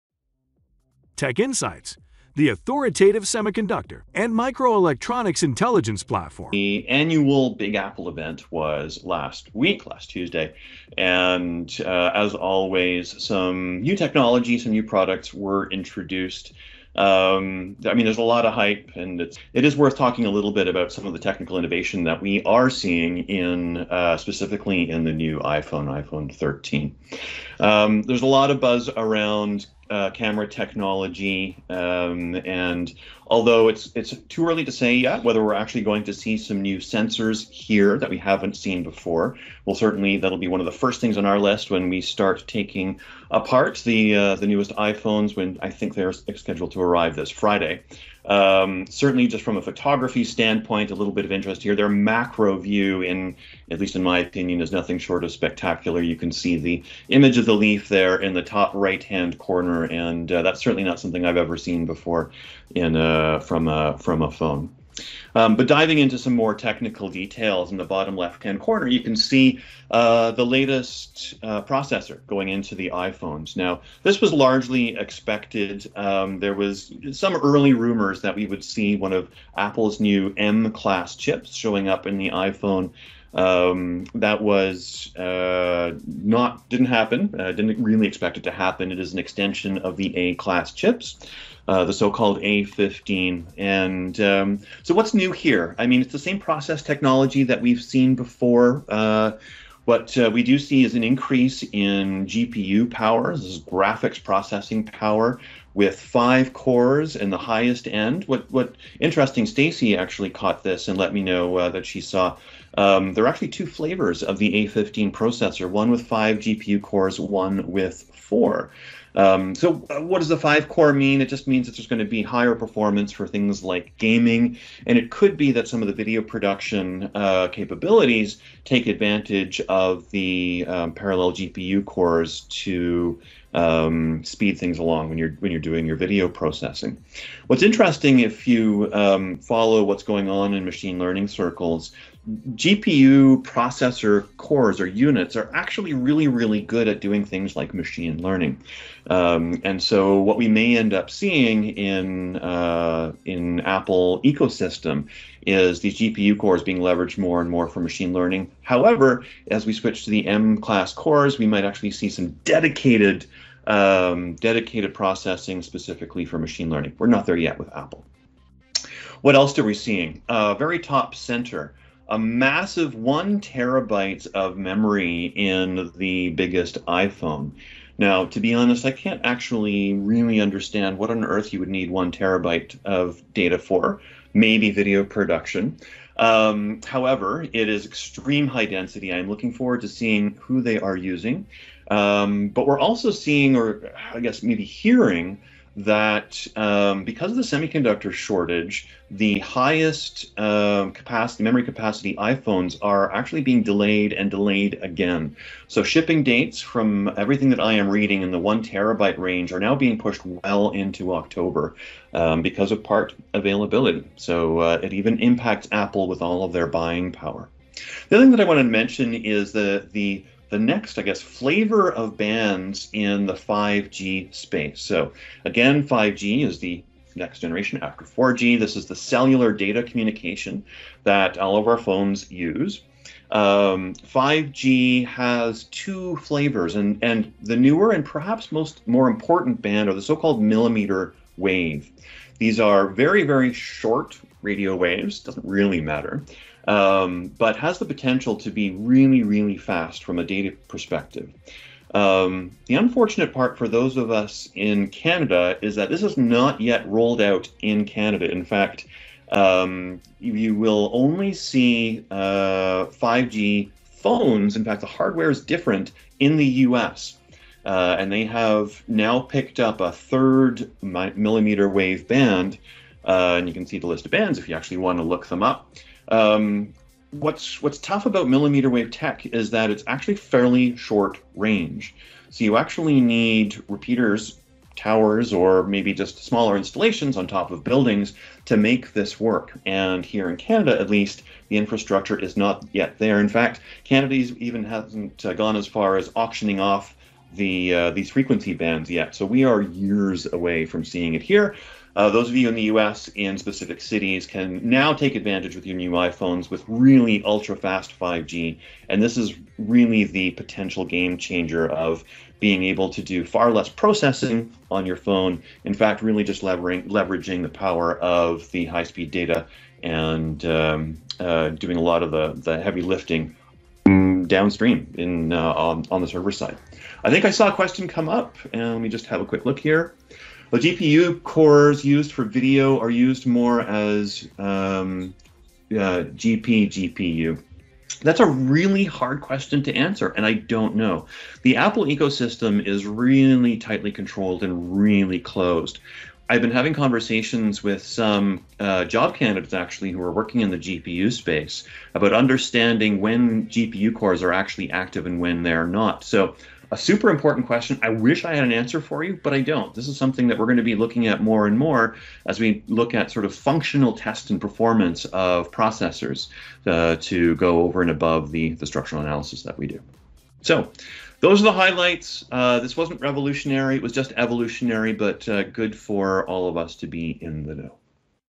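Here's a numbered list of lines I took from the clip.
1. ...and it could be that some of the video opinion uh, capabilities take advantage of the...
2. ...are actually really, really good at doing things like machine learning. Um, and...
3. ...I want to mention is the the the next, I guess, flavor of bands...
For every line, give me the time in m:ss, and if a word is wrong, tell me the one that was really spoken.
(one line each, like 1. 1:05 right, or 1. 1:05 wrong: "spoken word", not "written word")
1. 2:04 wrong: "production", not "opinion"
2. 2:25 right
3. 3:38 right.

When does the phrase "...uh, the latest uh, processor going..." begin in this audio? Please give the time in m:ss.
1:09.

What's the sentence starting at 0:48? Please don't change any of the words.
Um, certainly, just from a photography standpoint, a little bit of interest here.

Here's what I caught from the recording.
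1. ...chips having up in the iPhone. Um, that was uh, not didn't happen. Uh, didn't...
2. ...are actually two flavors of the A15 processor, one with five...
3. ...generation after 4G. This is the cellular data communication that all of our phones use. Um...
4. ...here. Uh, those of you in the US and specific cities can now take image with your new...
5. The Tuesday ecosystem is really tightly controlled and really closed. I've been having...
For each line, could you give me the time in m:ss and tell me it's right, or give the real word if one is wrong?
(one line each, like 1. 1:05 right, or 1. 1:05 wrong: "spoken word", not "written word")
1. 1:21 wrong: "showing", not "having"
2. 1:53 right
3. 3:47 right
4. 5:01 wrong: "advantage", not "image"
5. 5:41 wrong: "Apple", not "Tuesday".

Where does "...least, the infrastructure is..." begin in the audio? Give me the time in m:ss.
4:50.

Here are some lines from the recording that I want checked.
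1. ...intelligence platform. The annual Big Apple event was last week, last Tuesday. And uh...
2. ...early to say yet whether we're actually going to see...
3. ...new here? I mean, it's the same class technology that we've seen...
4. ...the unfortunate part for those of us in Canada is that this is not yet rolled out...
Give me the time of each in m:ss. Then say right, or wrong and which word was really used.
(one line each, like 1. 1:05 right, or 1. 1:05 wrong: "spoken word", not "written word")
1. 0:05 right
2. 0:34 right
3. 1:35 wrong: "process", not "class"
4. 4:12 right.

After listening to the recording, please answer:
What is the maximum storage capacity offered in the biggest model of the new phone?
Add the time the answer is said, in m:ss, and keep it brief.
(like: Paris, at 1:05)
1 terabyte, at 2:52.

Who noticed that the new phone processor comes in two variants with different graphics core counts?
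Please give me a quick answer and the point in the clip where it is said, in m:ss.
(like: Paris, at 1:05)
Stacy, at 1:49.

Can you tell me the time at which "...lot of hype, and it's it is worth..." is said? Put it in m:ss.
0:18.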